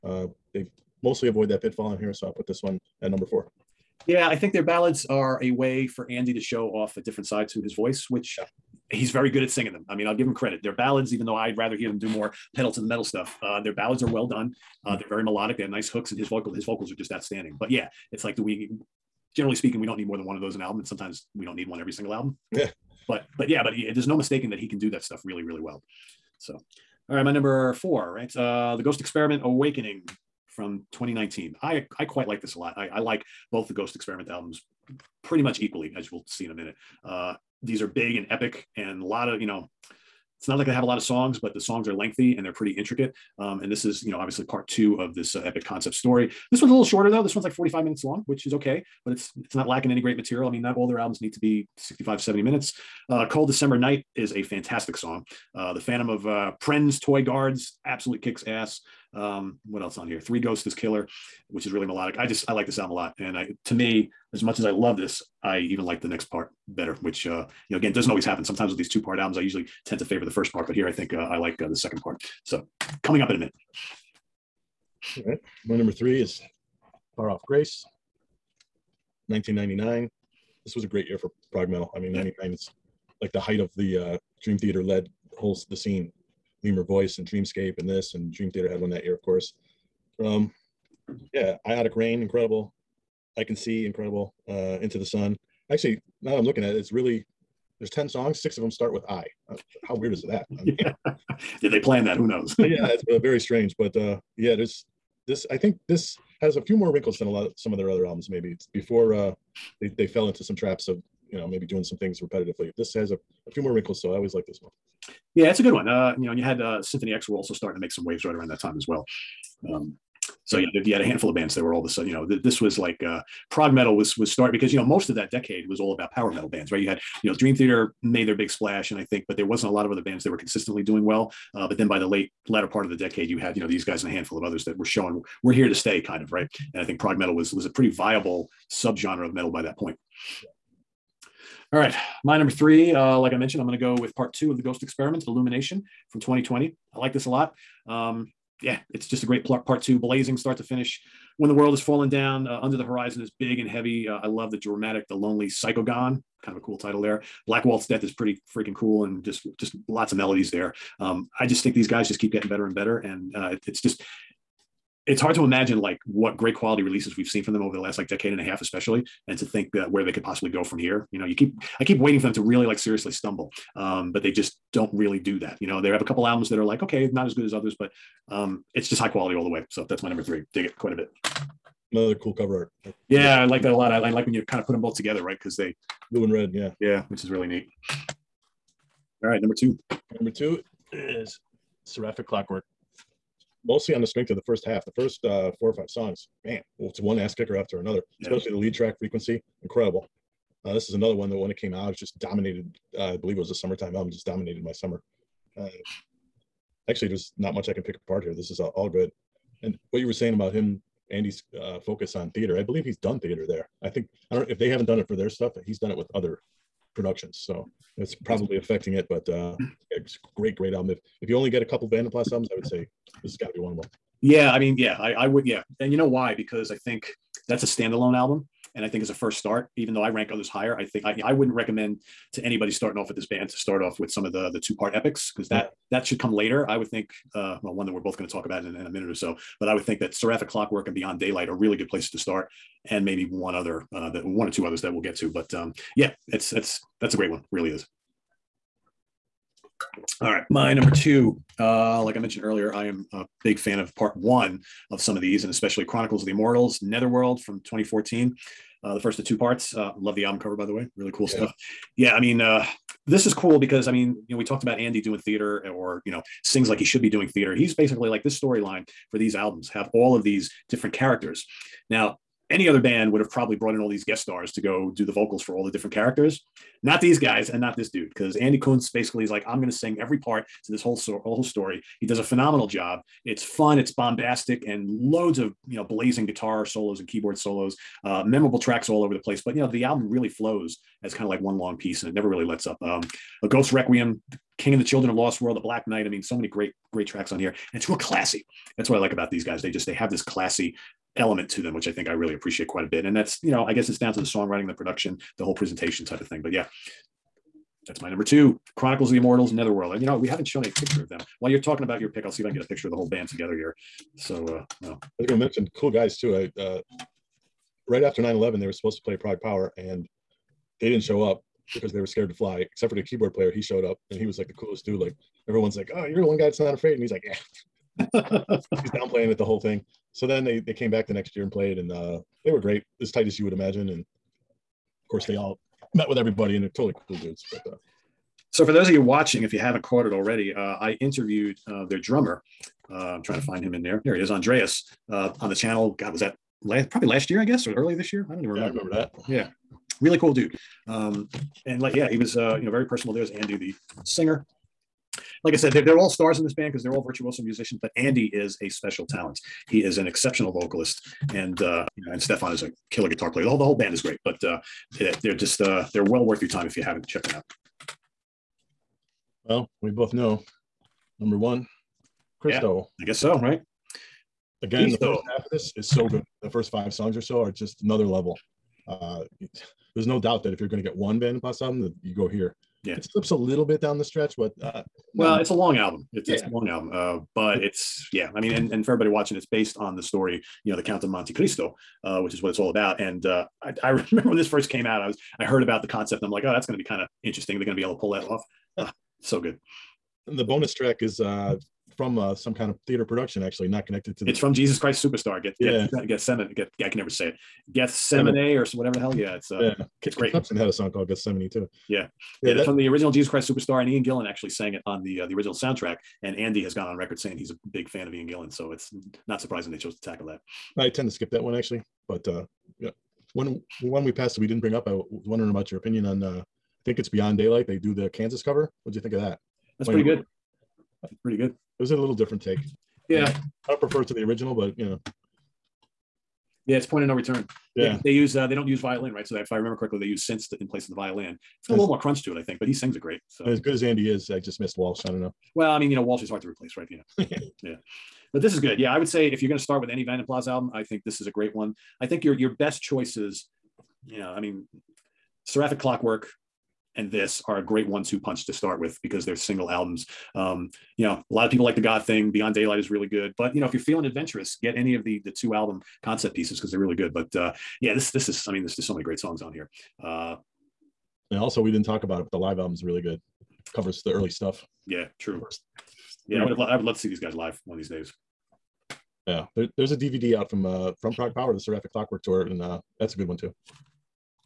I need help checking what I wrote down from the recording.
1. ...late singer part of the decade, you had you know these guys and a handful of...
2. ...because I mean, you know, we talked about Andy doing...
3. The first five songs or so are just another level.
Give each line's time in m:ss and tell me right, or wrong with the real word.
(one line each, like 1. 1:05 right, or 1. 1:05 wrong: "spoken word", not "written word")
1. 2:12 wrong: "latter", not "singer"
2. 4:23 right
3. 6:16 right.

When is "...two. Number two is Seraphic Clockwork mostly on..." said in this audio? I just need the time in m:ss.
3:09.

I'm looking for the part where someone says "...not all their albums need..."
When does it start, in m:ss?
0:50.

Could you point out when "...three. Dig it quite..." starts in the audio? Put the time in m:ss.
3:00.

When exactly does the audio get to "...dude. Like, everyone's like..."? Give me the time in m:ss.
5:24.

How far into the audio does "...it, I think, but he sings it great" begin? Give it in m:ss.
7:22.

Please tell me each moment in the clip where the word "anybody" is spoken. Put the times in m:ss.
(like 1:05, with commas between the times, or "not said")
3:52.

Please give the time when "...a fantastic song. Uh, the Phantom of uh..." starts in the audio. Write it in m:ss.
0:54.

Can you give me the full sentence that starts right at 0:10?
Their ballads, even though I'd rather hear them do more pedal to the metal stuff, uh, their ballads are well done.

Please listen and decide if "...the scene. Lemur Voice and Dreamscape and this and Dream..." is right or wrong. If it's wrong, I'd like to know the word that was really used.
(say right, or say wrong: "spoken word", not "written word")
right.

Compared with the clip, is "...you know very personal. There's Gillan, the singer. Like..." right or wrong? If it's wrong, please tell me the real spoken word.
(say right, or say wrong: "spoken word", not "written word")
wrong: "Andy", not "Gillan".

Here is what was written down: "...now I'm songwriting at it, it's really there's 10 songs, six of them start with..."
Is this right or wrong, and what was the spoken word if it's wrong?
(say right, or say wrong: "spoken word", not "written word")
wrong: "looking", not "songwriting".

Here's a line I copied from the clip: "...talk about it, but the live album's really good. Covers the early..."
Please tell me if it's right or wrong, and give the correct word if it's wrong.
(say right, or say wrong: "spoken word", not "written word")
right.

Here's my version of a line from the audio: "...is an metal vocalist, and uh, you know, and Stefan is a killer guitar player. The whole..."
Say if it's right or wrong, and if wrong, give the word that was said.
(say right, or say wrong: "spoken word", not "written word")
wrong: "exceptional", not "metal".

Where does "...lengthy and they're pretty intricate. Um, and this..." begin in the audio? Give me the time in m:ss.
0:41.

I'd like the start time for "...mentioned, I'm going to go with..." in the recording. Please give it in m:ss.
2:23.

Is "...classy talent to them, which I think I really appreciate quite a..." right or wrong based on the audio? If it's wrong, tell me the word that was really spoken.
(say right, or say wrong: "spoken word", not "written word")
wrong: "element", not "talent".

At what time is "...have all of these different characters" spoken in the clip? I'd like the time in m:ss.
4:29.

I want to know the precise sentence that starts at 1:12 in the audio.
So coming up in a minute.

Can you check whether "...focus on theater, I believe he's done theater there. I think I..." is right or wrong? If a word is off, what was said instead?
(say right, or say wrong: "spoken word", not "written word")
right.